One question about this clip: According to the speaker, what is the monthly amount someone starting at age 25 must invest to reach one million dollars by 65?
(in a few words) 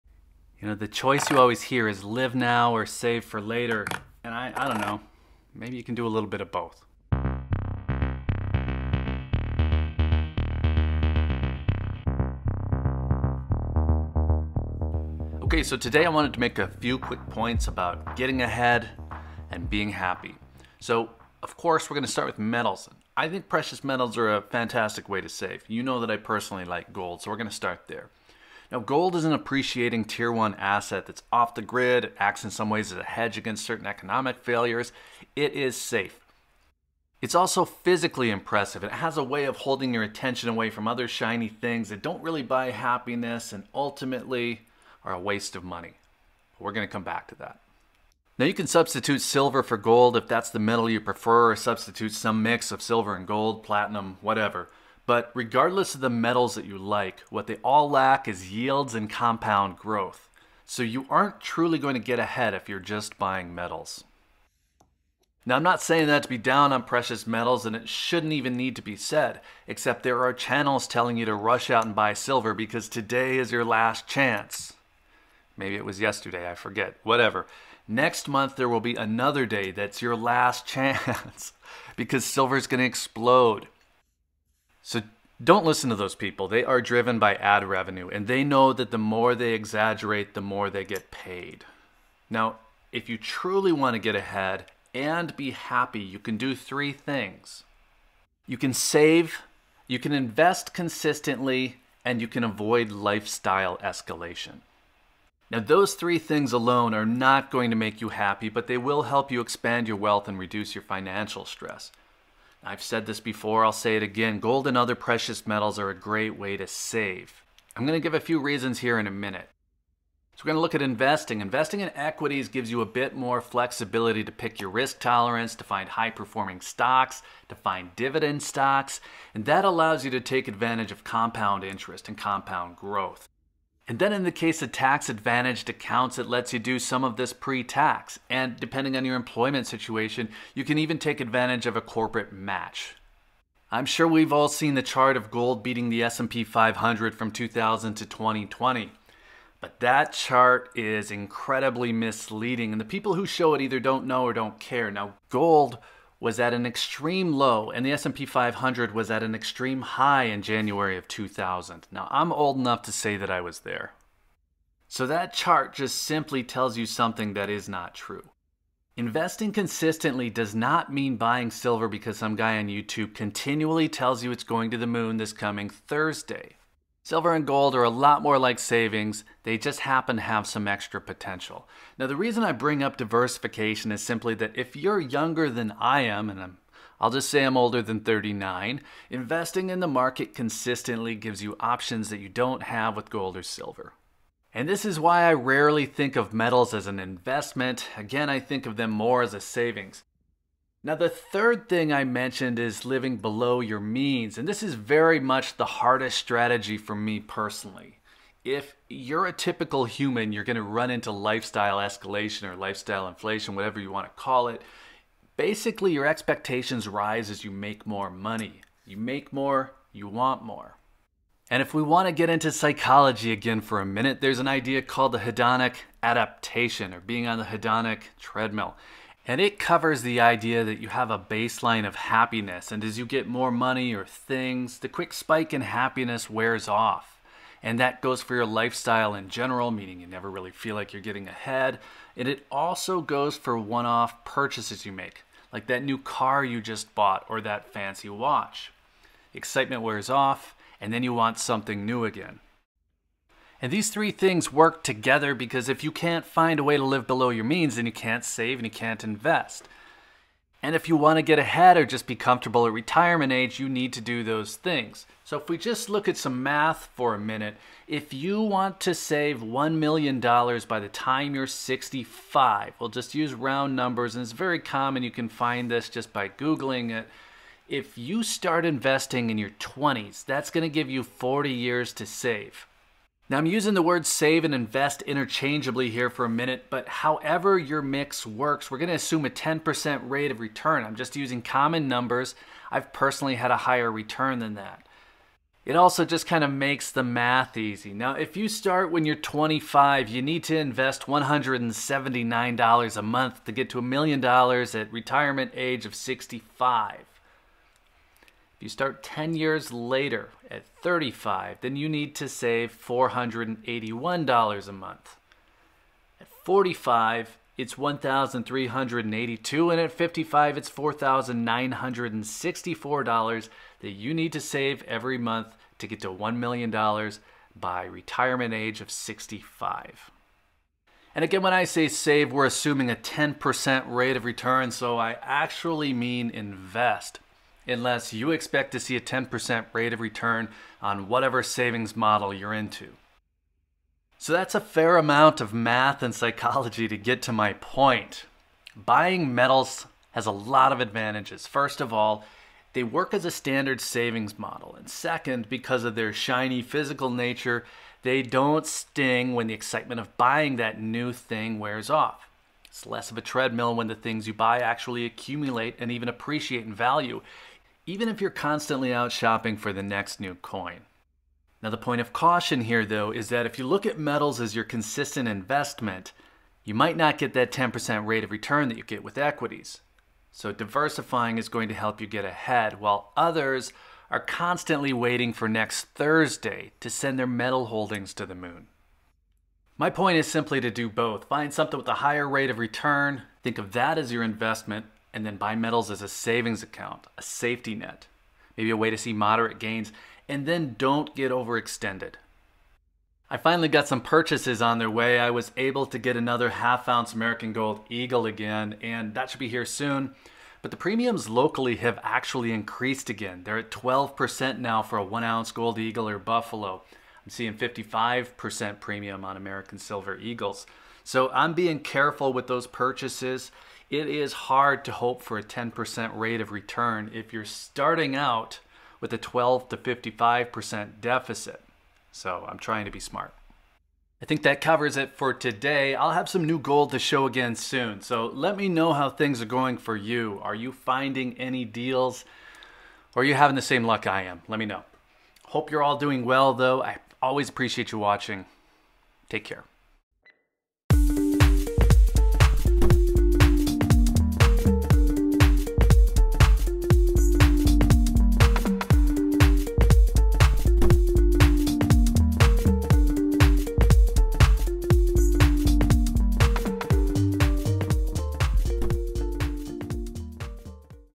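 $179.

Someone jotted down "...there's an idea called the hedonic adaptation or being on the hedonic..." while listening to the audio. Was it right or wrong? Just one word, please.
right.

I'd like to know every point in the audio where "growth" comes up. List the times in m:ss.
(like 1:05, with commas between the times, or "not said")
0:59, 2:12.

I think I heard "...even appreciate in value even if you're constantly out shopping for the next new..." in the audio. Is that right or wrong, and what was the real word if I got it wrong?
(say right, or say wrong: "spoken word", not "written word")
right.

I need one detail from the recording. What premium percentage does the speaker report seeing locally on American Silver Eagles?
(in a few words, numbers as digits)
55%.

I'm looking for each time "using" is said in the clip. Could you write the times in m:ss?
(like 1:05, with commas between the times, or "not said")
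4:43, 4:51.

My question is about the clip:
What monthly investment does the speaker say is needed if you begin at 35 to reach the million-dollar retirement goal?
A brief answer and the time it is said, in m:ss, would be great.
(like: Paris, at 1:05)
$481, at 5:12.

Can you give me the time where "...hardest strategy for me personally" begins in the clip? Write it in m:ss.
3:25.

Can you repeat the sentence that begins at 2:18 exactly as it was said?
And depending on your employment situation, you can even take advantage of a corporate match.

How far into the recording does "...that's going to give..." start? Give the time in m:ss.
4:40.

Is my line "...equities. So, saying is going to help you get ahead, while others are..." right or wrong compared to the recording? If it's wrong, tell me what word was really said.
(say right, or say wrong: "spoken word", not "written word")
wrong: "diversifying", not "saying".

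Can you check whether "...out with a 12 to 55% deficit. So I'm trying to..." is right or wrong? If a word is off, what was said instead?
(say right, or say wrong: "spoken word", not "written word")
right.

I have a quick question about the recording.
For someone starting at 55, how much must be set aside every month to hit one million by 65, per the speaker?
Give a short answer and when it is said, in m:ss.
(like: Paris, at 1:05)
$4,964, at 5:20.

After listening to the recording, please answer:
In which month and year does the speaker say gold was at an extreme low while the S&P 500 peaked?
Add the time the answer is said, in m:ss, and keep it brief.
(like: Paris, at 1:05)
January 2000, at 2:40.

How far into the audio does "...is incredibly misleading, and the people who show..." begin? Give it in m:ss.
2:30.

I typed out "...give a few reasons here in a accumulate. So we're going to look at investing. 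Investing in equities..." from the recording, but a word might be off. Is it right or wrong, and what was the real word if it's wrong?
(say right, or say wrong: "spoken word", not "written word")
wrong: "minute", not "accumulate".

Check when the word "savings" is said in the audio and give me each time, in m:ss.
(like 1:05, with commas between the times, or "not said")
2:58, 3:19, 5:41, 5:53, 6:36.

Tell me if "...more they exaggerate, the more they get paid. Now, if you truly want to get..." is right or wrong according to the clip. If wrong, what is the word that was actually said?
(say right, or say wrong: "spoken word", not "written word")
right.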